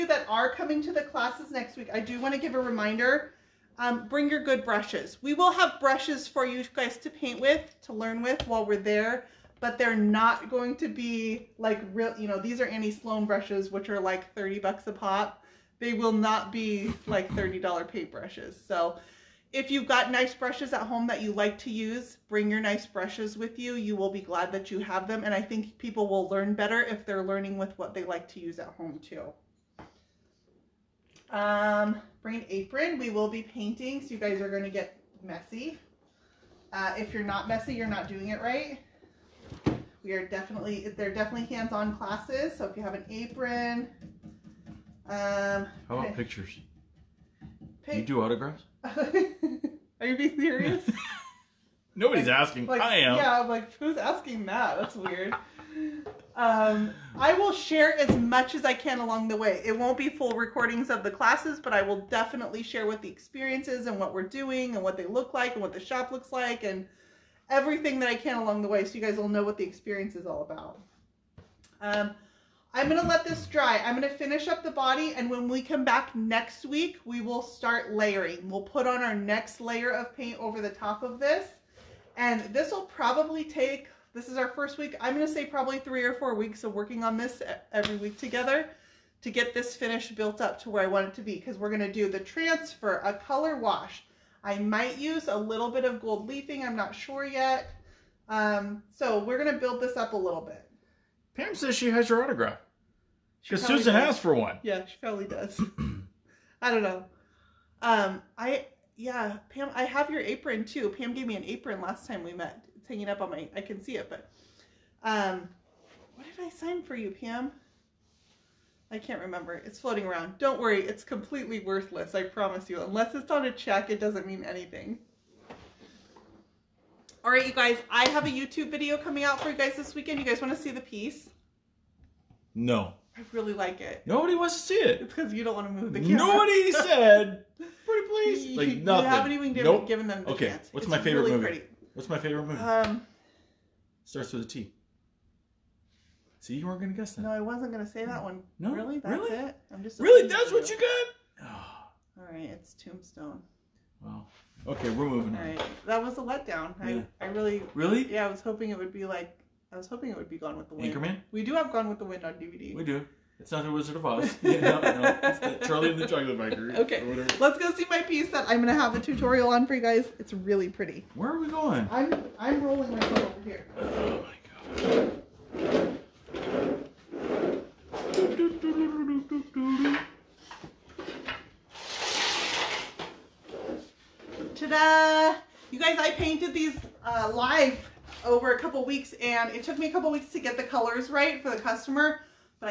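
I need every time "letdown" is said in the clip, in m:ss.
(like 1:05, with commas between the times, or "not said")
2:36.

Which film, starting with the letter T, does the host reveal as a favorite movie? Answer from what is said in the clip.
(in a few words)
Tombstone.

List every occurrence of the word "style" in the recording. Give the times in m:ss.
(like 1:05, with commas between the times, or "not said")
not said.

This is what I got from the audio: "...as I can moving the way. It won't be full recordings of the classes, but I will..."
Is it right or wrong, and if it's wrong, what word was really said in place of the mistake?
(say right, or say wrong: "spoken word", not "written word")
wrong: "along", not "moving".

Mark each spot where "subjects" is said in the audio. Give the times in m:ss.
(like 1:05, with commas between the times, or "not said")
not said.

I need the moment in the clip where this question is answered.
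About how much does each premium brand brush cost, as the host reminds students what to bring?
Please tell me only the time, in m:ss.
0:14.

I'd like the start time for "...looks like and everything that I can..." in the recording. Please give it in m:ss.
1:06.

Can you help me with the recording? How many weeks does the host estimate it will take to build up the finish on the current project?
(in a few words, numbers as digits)
3 or 4 weeks.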